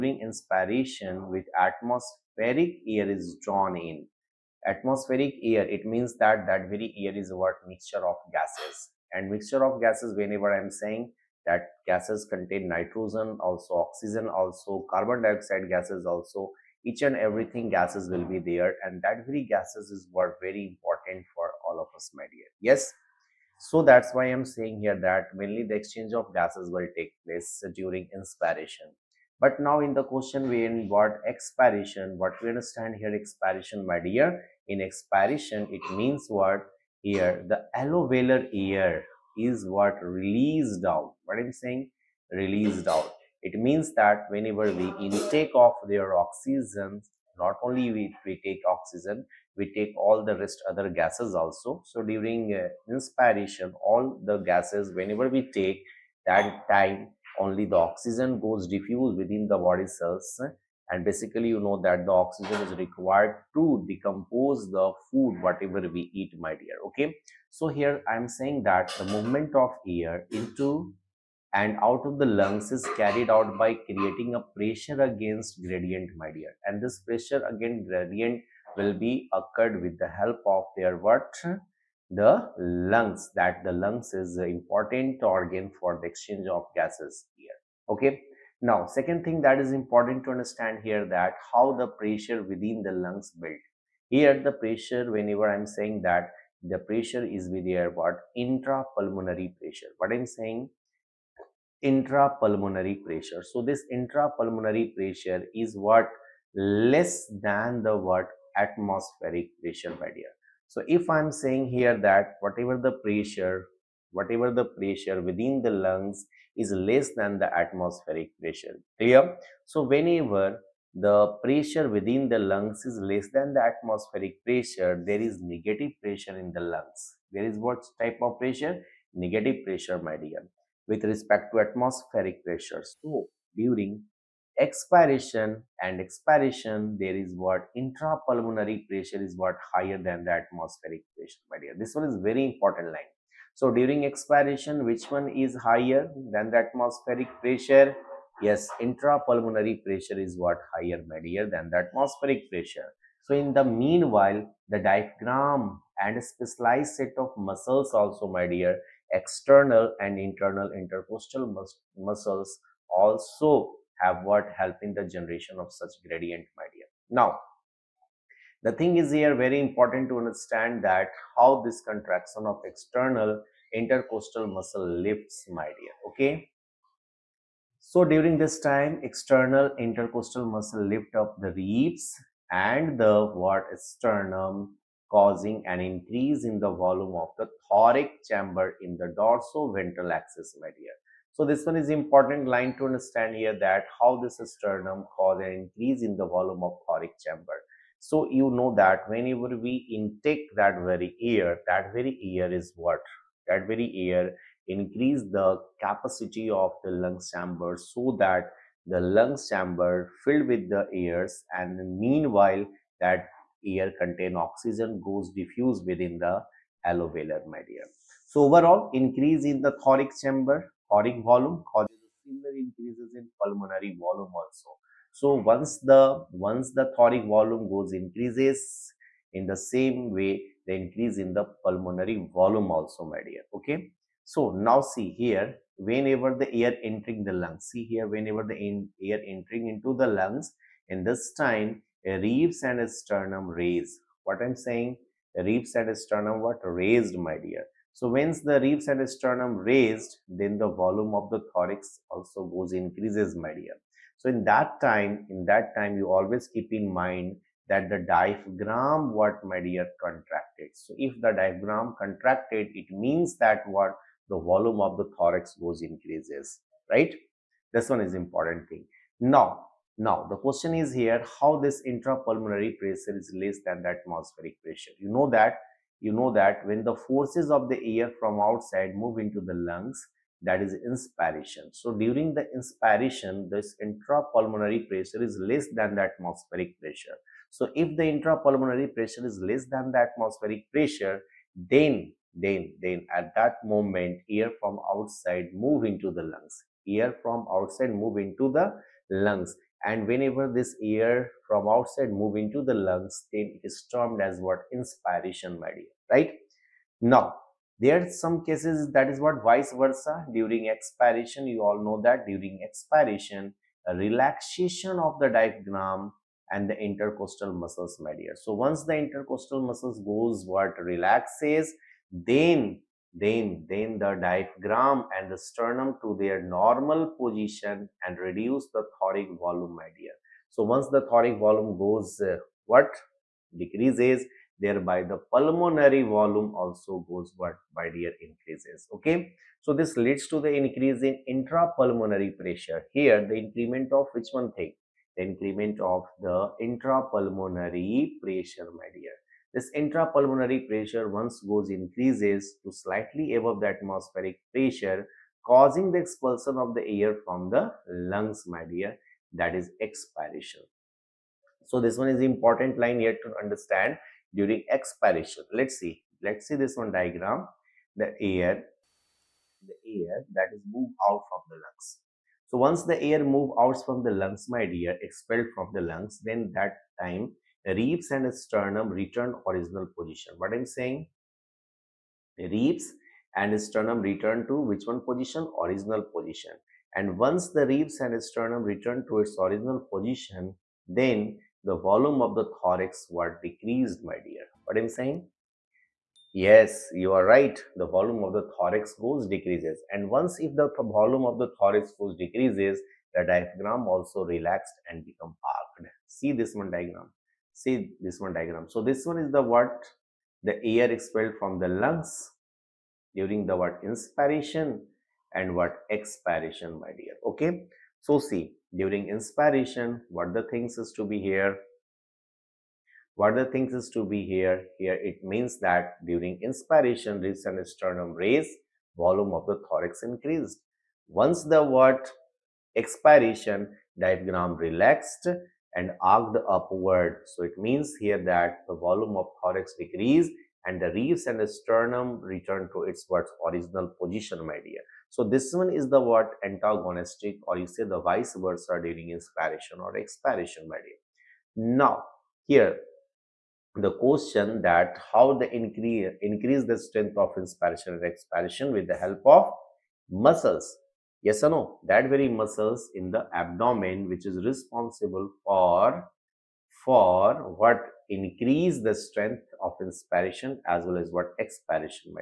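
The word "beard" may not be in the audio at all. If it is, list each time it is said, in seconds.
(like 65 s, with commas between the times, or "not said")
not said.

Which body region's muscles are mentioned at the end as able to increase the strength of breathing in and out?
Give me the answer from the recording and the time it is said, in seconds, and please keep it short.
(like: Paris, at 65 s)
Abdomen, at 463 s.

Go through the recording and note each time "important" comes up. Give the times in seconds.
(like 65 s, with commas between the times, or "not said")
20 s, 84 s, 89 s, 142 s, 169 s, 191 s, 268 s, 362 s.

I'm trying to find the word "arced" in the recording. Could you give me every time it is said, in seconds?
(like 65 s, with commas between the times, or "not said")
436 s.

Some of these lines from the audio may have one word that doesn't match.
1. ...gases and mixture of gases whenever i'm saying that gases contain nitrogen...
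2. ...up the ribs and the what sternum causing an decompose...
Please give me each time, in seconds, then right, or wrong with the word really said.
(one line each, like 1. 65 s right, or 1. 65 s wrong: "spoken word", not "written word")
1. 8 s right
2. 181 s wrong: "increase", not "decompose".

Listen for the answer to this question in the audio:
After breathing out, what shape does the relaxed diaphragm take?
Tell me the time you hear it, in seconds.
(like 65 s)
405 s.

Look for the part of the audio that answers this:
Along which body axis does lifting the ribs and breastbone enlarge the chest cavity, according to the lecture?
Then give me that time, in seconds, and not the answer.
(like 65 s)
189 s.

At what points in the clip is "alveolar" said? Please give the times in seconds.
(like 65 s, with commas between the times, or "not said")
37 s, 216 s.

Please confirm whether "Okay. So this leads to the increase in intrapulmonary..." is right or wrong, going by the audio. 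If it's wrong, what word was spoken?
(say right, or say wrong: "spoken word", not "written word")
right.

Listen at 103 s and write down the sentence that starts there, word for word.
So this intrapulmonary pressure is what less than the what atmospheric pressure dear.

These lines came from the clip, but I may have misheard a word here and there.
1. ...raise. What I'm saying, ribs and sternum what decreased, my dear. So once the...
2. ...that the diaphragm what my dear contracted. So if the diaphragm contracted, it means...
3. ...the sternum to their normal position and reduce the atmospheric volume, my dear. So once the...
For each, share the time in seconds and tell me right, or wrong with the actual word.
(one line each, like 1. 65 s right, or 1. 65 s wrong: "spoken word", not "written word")
1. 243 s wrong: "raised", not "decreased"
2. 257 s right
3. 325 s wrong: "thoracic", not "atmospheric".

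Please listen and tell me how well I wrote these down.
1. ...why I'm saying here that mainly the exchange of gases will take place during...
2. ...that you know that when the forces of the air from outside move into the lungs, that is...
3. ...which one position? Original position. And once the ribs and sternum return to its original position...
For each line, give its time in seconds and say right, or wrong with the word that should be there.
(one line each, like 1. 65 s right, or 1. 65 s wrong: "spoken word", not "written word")
1. 24 s right
2. 275 s right
3. 384 s right.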